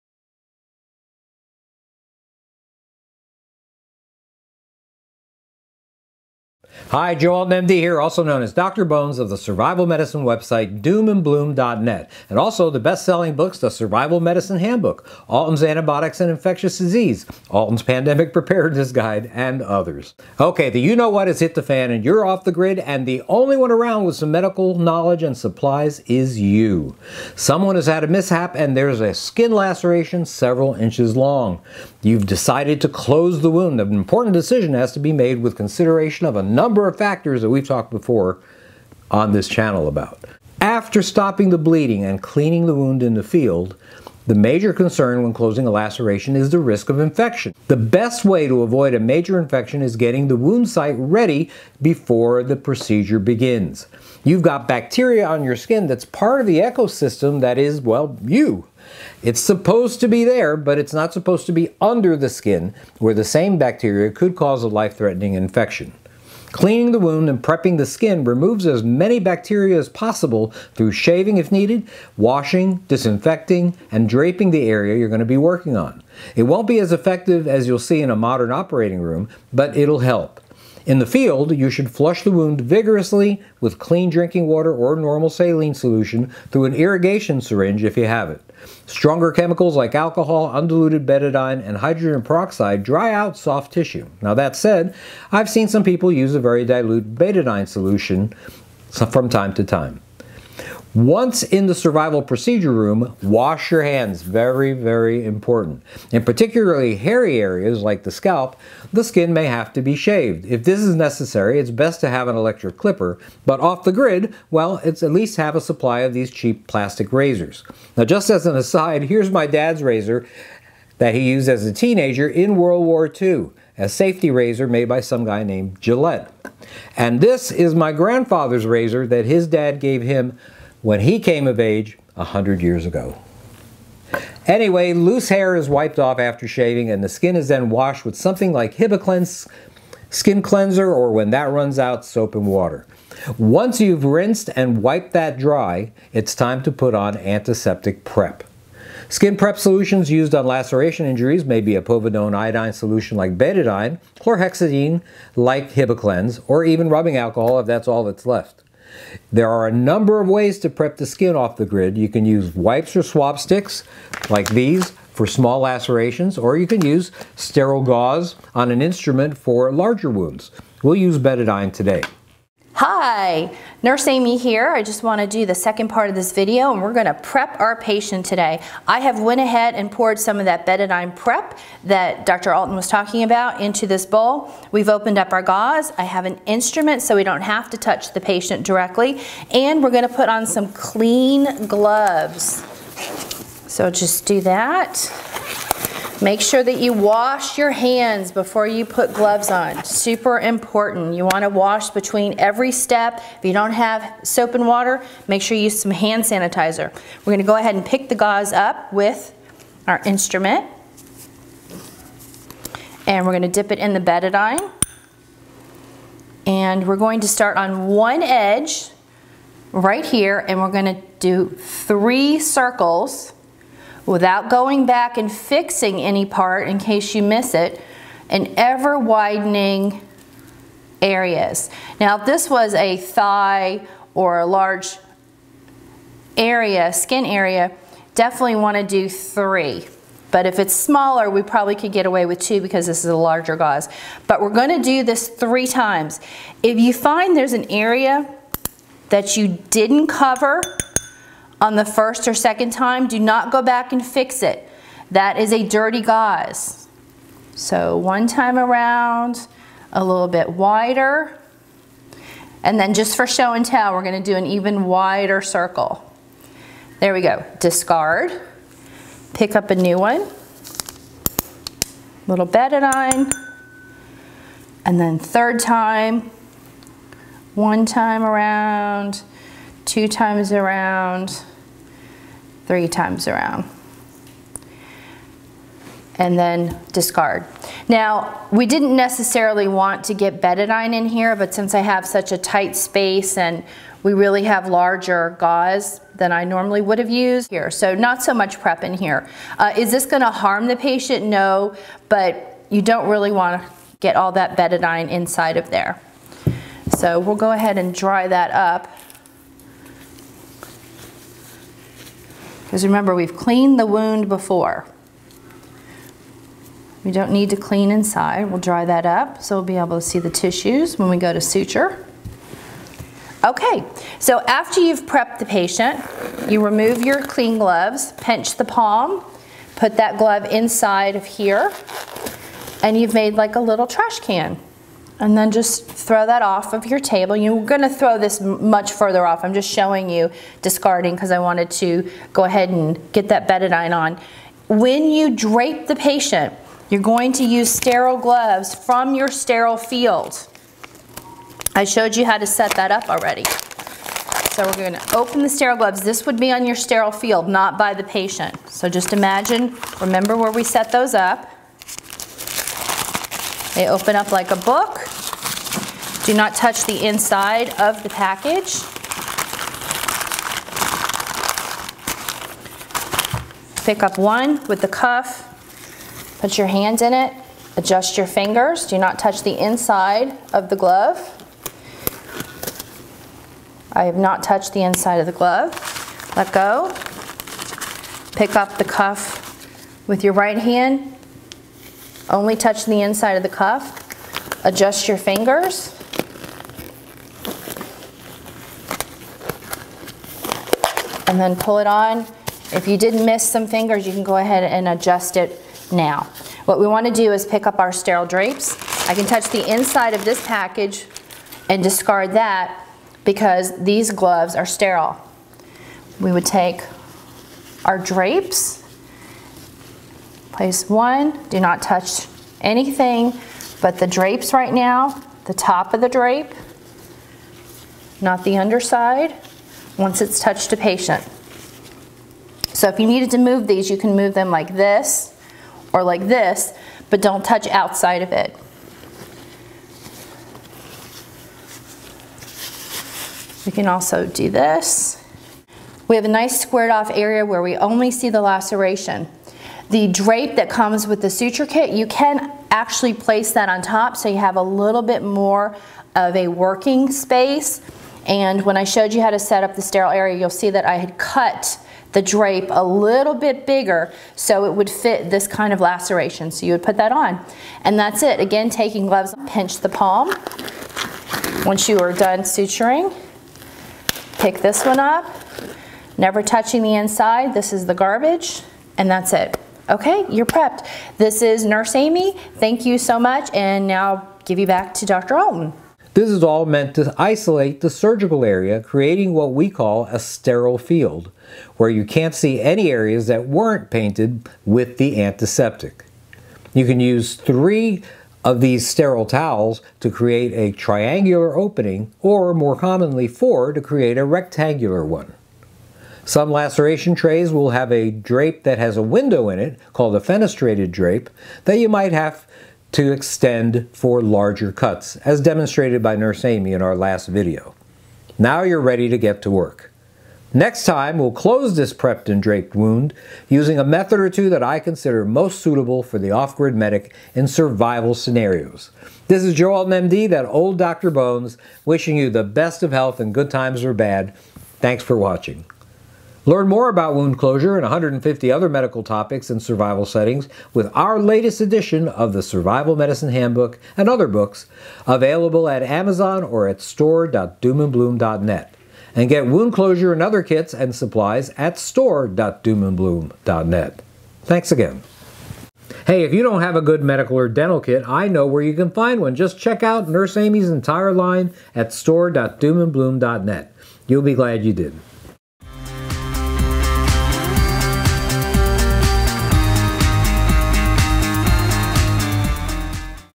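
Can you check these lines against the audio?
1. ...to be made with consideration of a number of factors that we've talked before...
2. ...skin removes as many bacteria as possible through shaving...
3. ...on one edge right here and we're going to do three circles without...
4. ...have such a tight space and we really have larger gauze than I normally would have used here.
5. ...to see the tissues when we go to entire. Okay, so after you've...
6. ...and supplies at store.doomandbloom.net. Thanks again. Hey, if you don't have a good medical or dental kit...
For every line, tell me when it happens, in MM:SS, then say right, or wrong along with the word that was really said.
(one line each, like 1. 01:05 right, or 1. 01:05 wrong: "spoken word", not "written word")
1. 00:34 right
2. 01:07 right
3. 03:37 right
4. 04:51 right
5. 05:19 wrong: "suture", not "entire"
6. 09:10 right.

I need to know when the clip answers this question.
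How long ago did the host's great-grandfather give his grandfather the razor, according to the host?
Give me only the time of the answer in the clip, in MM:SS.
02:12.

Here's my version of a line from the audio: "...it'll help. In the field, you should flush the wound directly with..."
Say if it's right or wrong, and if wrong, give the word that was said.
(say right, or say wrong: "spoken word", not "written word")
wrong: "vigorously", not "directly".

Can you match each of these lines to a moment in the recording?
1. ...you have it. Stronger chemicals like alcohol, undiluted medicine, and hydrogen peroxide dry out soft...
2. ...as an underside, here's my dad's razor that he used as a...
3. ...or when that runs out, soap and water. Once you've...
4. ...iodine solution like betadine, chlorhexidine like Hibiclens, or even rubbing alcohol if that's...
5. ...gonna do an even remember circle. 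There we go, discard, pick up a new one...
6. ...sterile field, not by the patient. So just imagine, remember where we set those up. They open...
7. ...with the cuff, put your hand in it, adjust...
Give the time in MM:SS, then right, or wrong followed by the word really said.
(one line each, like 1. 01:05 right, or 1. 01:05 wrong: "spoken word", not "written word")
1. 01:27 wrong: "betadine", not "medicine"
2. 01:58 wrong: "aside", not "underside"
3. 02:20 right
4. 02:32 right
5. 04:24 wrong: "wider", not "remember"
6. 05:56 right
7. 06:14 right.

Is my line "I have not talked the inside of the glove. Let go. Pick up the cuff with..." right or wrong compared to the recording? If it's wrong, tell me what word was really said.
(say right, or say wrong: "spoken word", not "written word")
wrong: "touched", not "talked".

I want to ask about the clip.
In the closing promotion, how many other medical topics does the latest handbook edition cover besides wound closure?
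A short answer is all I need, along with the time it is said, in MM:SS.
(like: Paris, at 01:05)
150, at 08:57.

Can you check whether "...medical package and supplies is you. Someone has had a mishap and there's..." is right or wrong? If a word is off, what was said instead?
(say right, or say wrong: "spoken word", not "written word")
wrong: "knowledge", not "package".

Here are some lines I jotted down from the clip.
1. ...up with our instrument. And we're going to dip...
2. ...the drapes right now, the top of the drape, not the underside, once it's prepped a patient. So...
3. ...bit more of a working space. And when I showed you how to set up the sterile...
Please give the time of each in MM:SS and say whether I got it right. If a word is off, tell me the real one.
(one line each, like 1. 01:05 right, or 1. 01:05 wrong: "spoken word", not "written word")
1. 03:28 right
2. 07:03 wrong: "touched", not "prepped"
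3. 07:35 right.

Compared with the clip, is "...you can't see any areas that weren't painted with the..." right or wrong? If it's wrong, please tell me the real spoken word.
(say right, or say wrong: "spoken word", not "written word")
right.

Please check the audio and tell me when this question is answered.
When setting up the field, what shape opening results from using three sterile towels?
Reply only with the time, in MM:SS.
08:20.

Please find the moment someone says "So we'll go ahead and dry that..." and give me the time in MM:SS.
05:06.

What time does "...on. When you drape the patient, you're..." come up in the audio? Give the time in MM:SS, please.
05:43.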